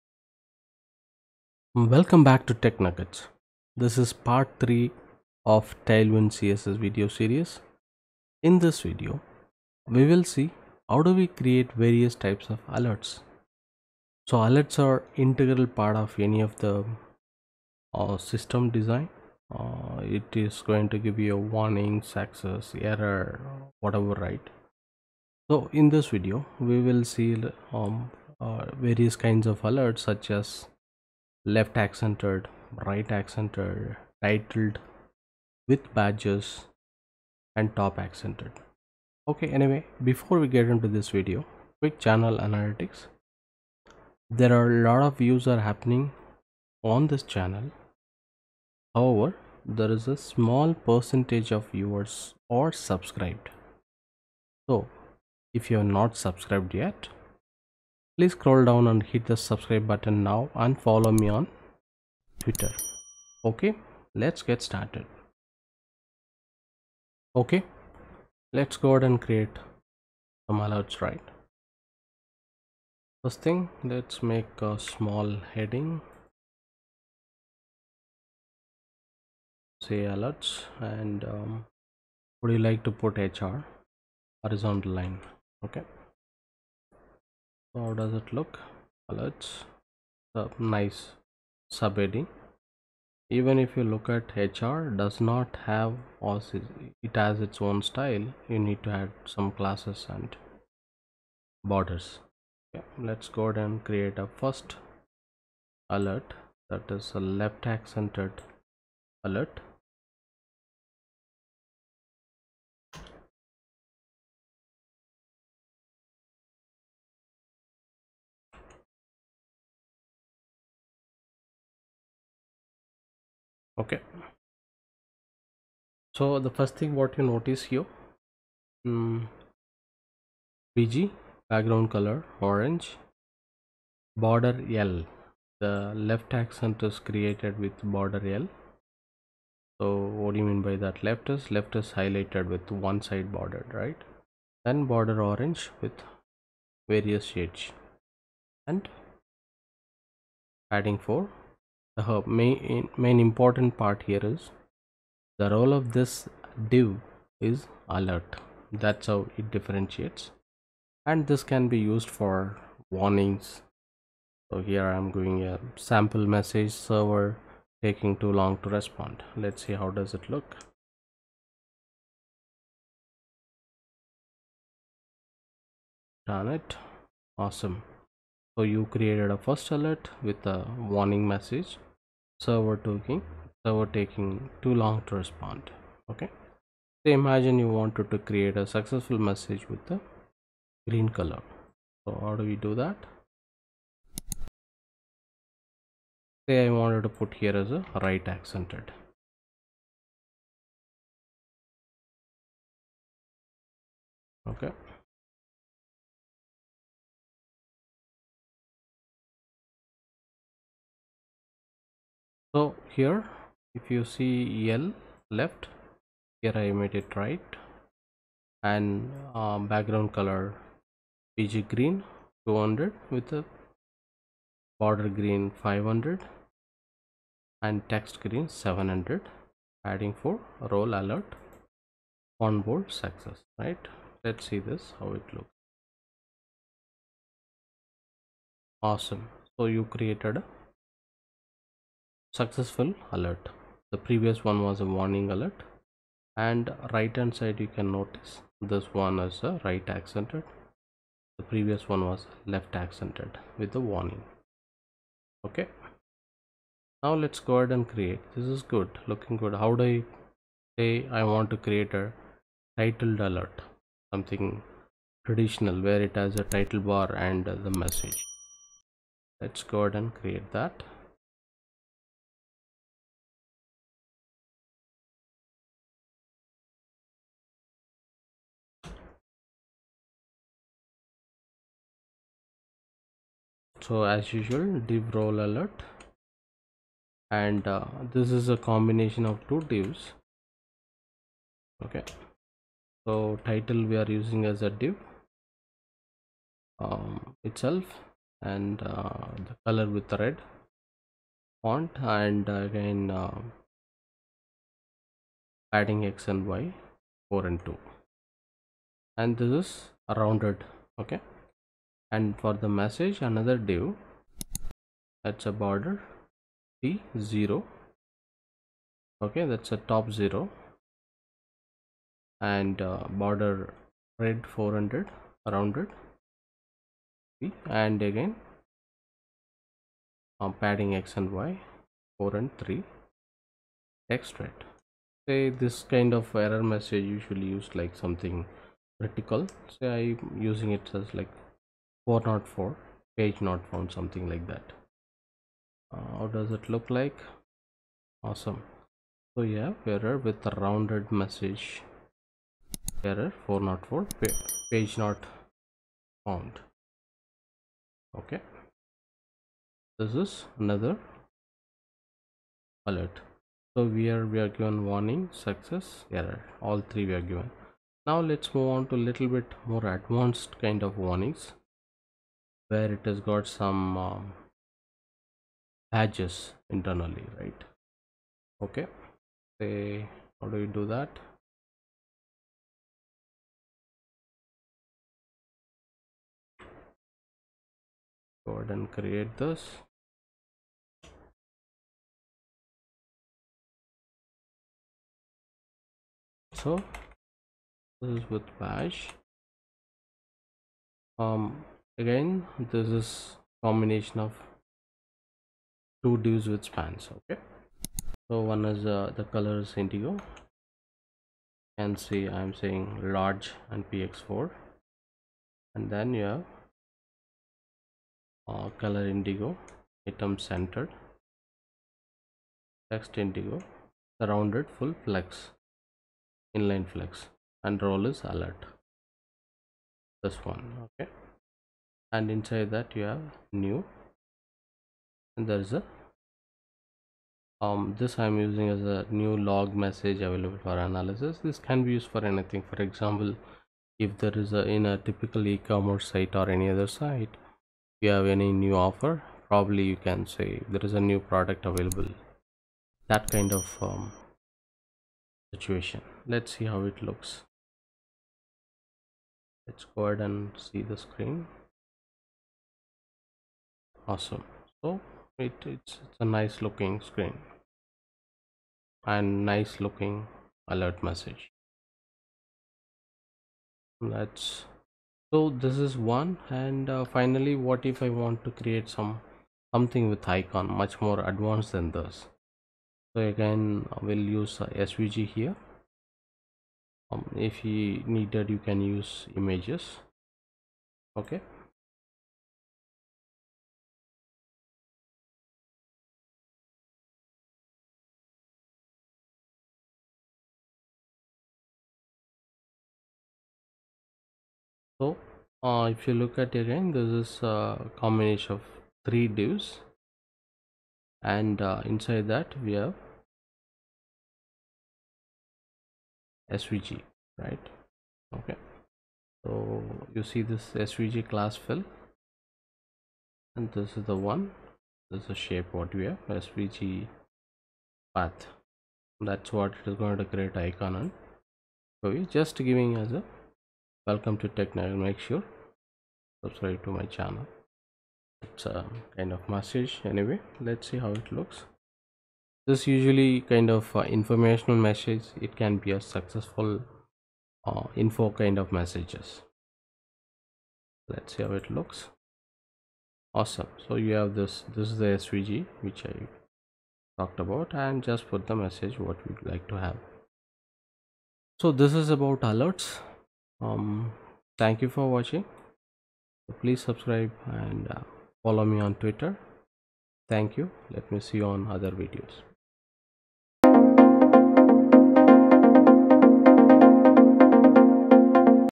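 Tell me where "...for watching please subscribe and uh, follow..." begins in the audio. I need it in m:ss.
9:24.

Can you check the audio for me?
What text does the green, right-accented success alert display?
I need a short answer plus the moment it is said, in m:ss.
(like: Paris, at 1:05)
Onboard success, at 3:52.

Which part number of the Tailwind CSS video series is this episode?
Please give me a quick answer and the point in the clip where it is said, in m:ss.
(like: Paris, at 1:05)
3, at 0:04.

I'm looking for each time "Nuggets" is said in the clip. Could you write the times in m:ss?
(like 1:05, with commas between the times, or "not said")
0:02, 8:54.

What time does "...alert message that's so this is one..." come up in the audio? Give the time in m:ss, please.
7:50.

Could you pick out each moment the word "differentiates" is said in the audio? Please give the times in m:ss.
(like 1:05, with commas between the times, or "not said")
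2:39.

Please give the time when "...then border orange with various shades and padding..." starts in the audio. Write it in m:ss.
2:24.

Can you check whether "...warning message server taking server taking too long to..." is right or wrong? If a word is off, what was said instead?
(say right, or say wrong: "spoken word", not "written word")
right.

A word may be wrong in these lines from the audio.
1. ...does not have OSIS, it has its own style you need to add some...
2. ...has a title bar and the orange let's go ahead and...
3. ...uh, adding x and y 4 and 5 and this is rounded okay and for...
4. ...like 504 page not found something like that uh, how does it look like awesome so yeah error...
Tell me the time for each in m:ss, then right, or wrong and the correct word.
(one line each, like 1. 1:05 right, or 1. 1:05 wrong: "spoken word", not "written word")
1. 1:34 right
2. 4:26 wrong: "message", not "orange"
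3. 5:03 wrong: "2", not "5"
4. 5:41 wrong: "404", not "504".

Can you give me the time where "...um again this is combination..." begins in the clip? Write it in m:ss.
6:41.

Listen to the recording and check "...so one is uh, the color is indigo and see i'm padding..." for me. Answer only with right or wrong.
wrong.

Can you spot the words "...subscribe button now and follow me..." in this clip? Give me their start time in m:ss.
0:59.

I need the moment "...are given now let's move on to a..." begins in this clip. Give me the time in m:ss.
6:07.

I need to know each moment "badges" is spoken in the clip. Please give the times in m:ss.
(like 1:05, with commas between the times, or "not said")
0:35, 6:15.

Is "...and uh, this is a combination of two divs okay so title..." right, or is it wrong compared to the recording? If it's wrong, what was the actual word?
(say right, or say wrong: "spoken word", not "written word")
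right.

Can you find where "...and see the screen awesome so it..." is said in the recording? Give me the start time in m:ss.
7:40.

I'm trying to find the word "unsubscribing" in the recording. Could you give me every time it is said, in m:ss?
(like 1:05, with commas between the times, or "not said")
not said.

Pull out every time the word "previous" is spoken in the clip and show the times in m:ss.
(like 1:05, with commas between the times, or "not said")
4:04, 4:11.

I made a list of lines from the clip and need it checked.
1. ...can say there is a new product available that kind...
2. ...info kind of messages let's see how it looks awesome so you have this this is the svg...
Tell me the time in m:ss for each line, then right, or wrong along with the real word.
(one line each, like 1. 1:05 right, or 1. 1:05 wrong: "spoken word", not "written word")
1. 7:29 right
2. 9:07 right.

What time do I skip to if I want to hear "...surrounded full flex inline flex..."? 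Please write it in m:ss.
7:04.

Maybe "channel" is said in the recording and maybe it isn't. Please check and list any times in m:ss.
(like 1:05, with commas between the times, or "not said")
0:41, 0:47, 8:57.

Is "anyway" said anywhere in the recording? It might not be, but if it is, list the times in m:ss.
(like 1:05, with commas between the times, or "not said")
0:39, 9:00.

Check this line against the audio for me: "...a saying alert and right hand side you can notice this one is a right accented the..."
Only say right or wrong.
wrong.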